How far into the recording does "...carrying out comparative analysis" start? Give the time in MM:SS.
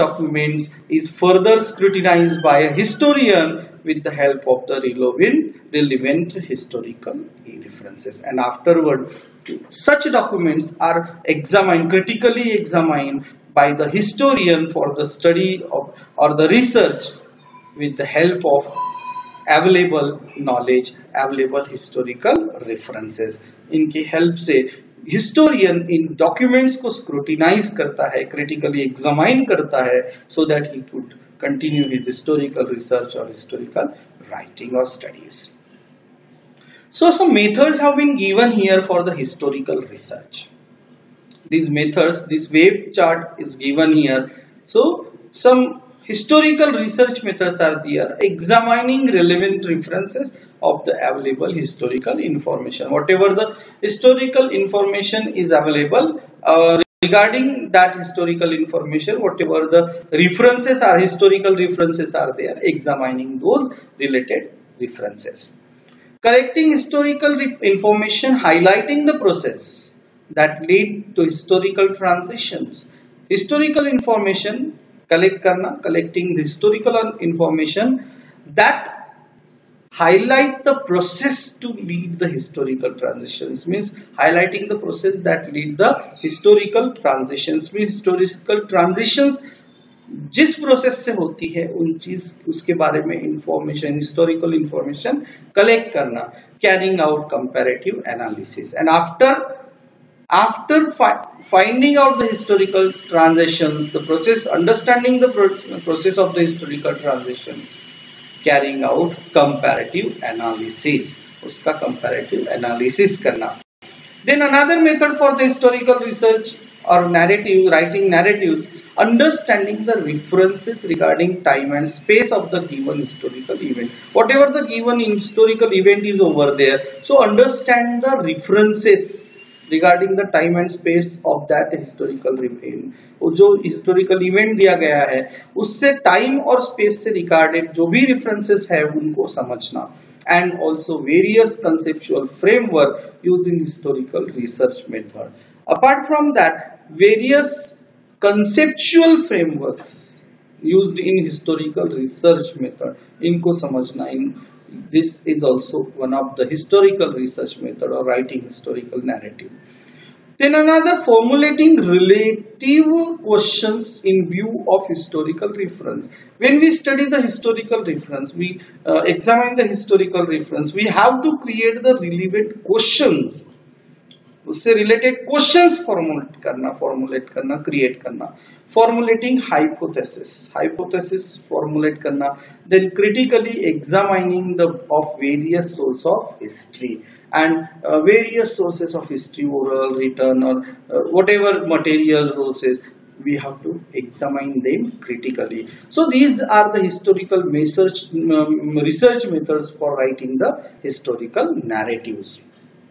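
01:48.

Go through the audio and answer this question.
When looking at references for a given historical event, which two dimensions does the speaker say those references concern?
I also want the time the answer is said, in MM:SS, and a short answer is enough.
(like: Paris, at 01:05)
Time and space, at 02:01.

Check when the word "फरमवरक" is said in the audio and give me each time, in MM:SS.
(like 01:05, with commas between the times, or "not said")
02:22, 02:29.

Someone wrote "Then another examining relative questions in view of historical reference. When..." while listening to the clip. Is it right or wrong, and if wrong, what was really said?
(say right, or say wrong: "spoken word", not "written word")
wrong: "formulating", not "examining".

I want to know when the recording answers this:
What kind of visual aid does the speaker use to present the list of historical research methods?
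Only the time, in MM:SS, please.
00:42.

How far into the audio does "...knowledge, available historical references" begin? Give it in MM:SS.
00:20.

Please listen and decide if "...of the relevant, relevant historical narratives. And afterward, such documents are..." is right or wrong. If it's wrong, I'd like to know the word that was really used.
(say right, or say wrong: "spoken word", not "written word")
wrong: "references", not "narratives".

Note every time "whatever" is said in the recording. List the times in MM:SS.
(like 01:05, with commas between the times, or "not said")
00:52, 00:59, 02:04.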